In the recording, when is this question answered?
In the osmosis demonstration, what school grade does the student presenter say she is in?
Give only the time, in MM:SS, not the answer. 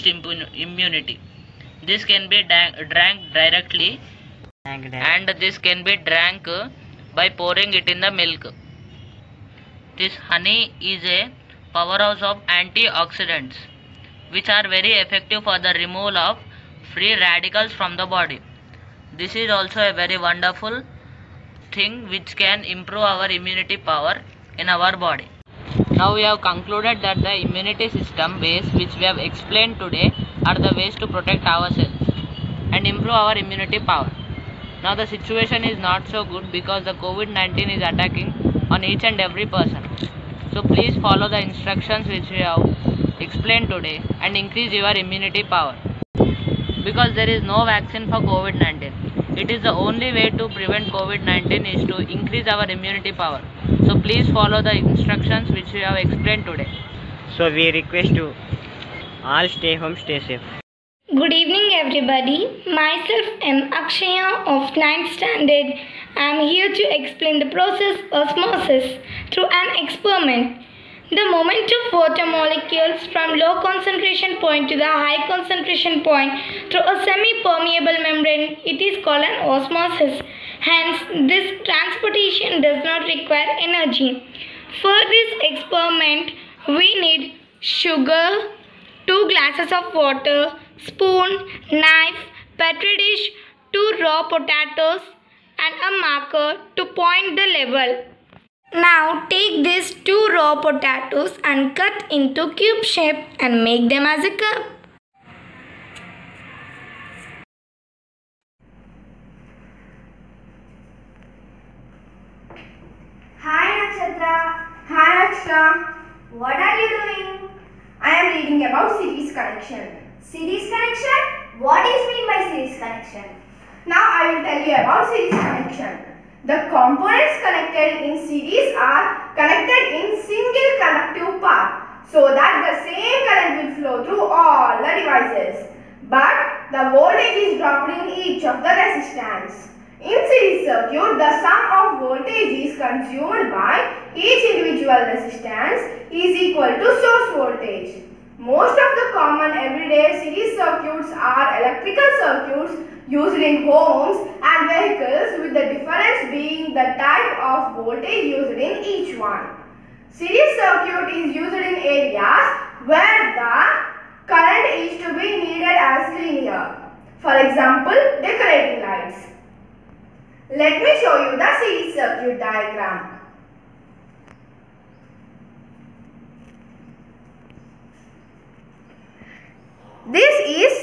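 01:04.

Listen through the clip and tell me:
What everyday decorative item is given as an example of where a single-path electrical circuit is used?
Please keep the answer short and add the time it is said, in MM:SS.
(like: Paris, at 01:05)
decorating lights, at 02:48.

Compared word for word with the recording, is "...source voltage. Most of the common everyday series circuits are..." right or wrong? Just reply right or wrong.
right.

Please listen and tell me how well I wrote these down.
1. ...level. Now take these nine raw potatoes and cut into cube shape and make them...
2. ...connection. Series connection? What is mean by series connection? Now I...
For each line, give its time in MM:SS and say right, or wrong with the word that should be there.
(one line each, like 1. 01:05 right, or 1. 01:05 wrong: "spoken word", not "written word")
1. 01:37 wrong: "two", not "nine"
2. 01:59 right.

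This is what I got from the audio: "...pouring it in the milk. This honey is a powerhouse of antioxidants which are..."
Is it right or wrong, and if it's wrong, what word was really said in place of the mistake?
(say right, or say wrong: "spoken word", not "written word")
right.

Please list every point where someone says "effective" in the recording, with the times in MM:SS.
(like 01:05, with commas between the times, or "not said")
00:15.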